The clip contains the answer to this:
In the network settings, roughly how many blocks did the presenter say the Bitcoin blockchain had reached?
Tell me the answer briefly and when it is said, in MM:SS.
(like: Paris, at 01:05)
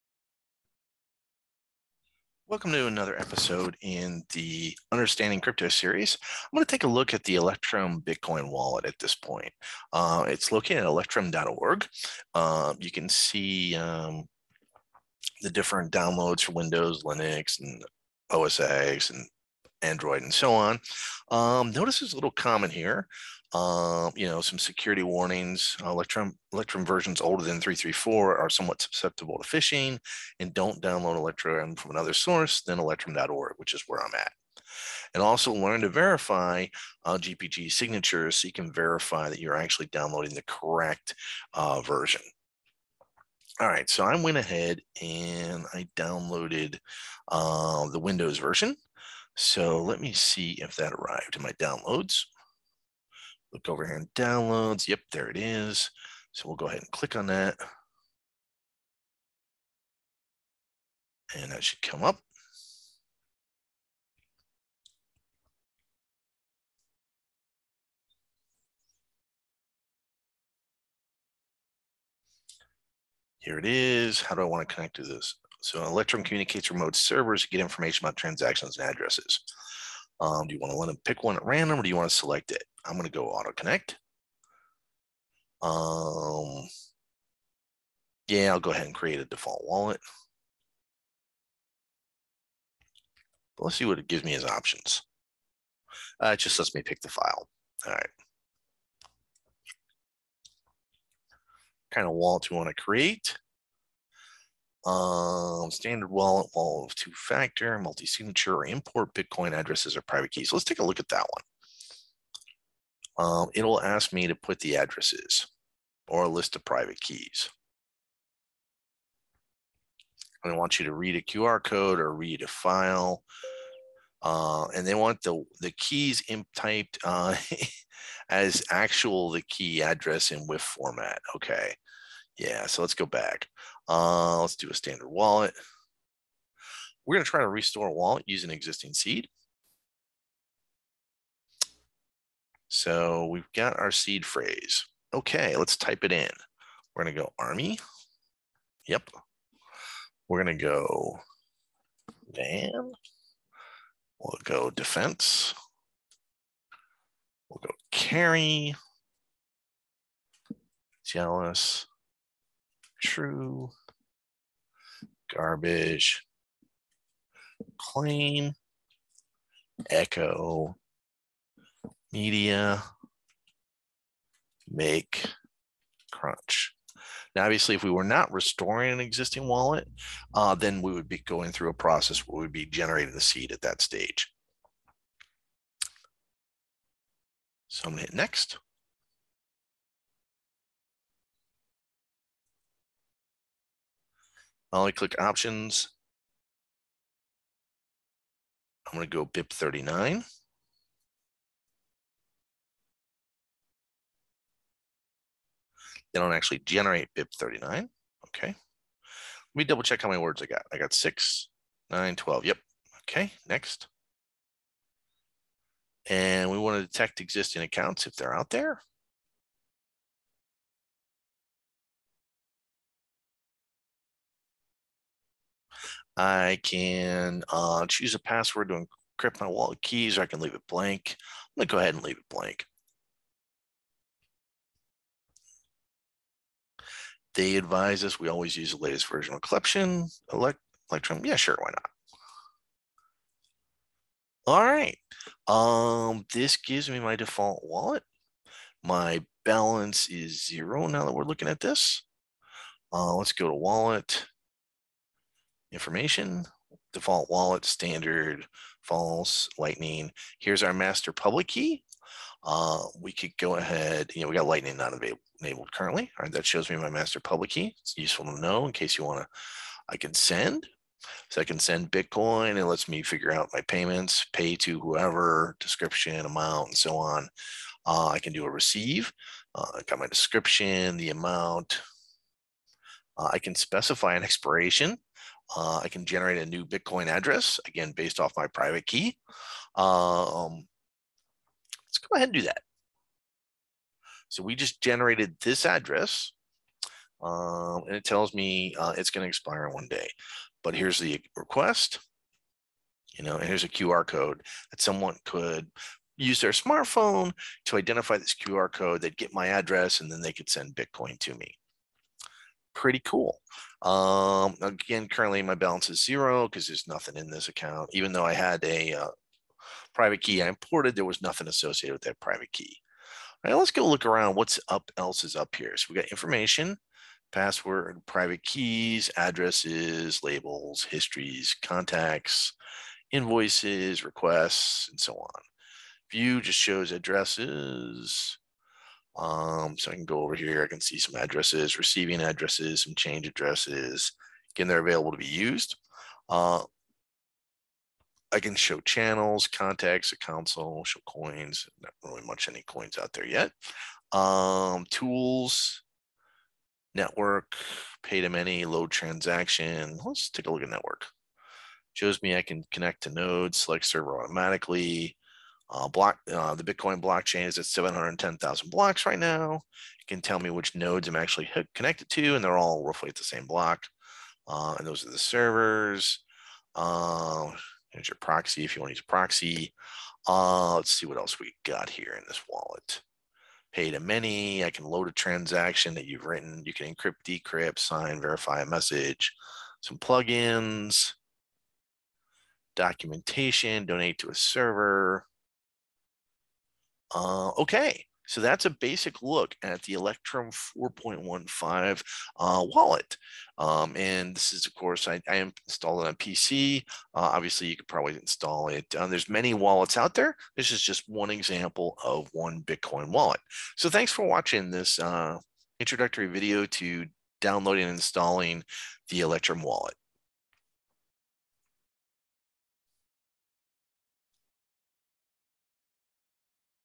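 710,000, at 06:07.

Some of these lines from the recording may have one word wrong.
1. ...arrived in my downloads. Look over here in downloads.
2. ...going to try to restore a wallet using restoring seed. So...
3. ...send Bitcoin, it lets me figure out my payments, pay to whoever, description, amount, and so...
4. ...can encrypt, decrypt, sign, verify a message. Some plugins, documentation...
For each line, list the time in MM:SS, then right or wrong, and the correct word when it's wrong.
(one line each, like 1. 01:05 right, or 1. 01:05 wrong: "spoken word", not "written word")
1. 00:50 right
2. 02:17 wrong: "existing", not "restoring"
3. 04:31 right
4. 06:26 right.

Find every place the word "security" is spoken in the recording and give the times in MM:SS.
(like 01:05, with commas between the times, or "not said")
00:24.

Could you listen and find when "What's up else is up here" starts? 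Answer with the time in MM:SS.
05:24.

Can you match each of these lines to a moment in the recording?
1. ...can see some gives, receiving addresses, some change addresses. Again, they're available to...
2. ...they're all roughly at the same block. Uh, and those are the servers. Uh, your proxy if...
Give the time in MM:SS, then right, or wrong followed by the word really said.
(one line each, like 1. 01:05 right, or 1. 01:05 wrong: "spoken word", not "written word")
1. 05:40 wrong: "addresses", not "gives"
2. 06:12 right.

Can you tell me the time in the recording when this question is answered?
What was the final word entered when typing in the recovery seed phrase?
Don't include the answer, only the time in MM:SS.
02:56.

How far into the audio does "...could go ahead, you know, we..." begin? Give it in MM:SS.
04:23.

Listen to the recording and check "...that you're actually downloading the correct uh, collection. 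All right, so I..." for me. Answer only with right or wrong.
wrong.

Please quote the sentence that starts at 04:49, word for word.
Um, let's go ahead and do that.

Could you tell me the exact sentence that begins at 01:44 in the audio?
Um, standard wallet, wallet of two factor, multi signature, or import Bitcoin addresses or private keys.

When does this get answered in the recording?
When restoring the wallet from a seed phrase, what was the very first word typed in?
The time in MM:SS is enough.
02:27.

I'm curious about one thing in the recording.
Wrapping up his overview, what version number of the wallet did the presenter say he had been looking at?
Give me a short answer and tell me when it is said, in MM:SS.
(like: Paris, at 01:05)
4.15, at 06:40.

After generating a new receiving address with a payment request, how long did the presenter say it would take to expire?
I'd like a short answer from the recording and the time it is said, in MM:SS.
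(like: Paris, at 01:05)
one day, at 04:59.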